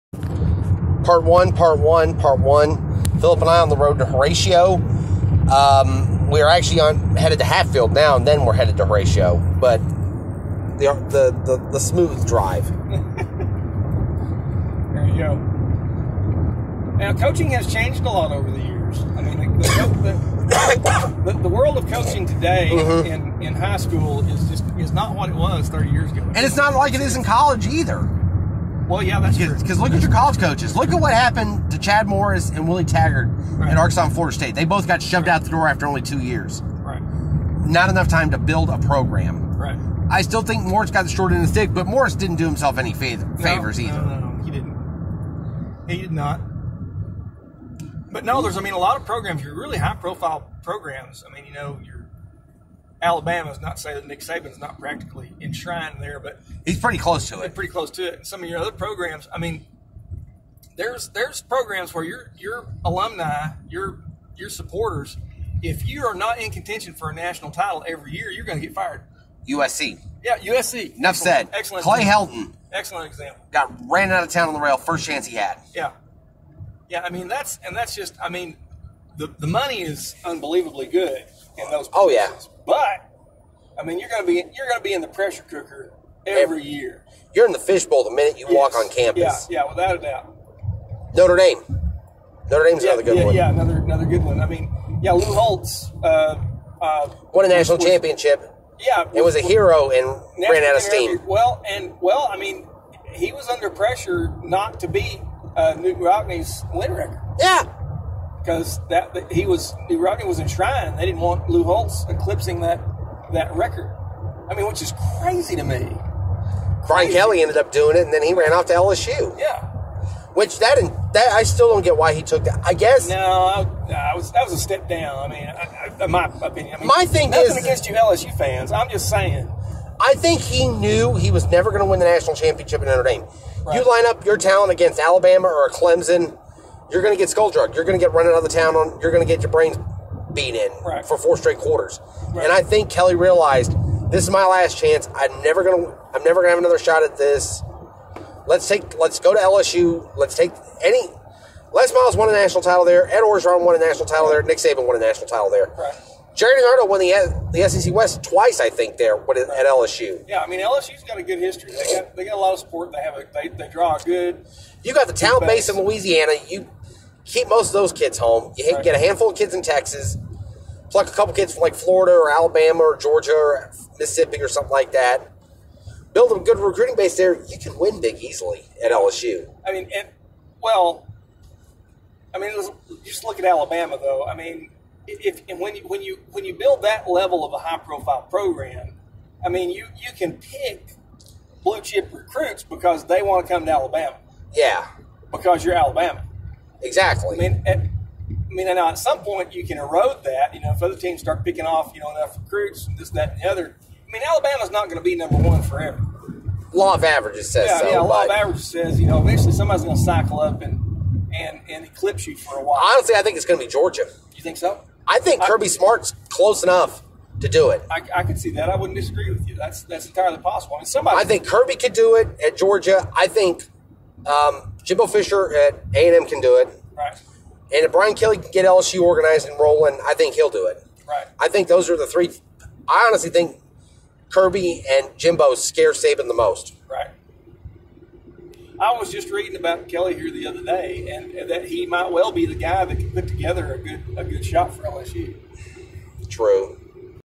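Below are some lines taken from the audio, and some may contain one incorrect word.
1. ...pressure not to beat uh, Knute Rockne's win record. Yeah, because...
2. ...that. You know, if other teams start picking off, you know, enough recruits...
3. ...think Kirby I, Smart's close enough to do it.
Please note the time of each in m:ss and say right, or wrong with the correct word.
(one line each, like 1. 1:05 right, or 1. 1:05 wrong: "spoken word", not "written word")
1. 1:43 right
2. 3:20 right
3. 3:35 right.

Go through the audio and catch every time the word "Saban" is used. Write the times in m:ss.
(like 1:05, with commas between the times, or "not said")
0:54, 2:34, 3:55.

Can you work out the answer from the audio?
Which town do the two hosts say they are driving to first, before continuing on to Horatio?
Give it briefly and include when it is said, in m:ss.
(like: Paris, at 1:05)
Hatfield, at 0:07.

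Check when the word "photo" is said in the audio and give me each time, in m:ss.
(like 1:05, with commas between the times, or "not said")
not said.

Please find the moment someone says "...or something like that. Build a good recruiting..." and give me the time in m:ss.
2:54.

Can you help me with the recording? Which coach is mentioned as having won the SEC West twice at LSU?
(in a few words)
Gerry DiNardo.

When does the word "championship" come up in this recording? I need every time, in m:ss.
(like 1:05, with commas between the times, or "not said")
1:37, 2:12.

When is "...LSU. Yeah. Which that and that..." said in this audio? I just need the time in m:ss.
1:58.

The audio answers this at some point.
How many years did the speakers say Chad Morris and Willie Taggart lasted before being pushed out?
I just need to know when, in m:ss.
0:36.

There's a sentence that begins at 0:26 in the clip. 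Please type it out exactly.
And it's not like it is in college either.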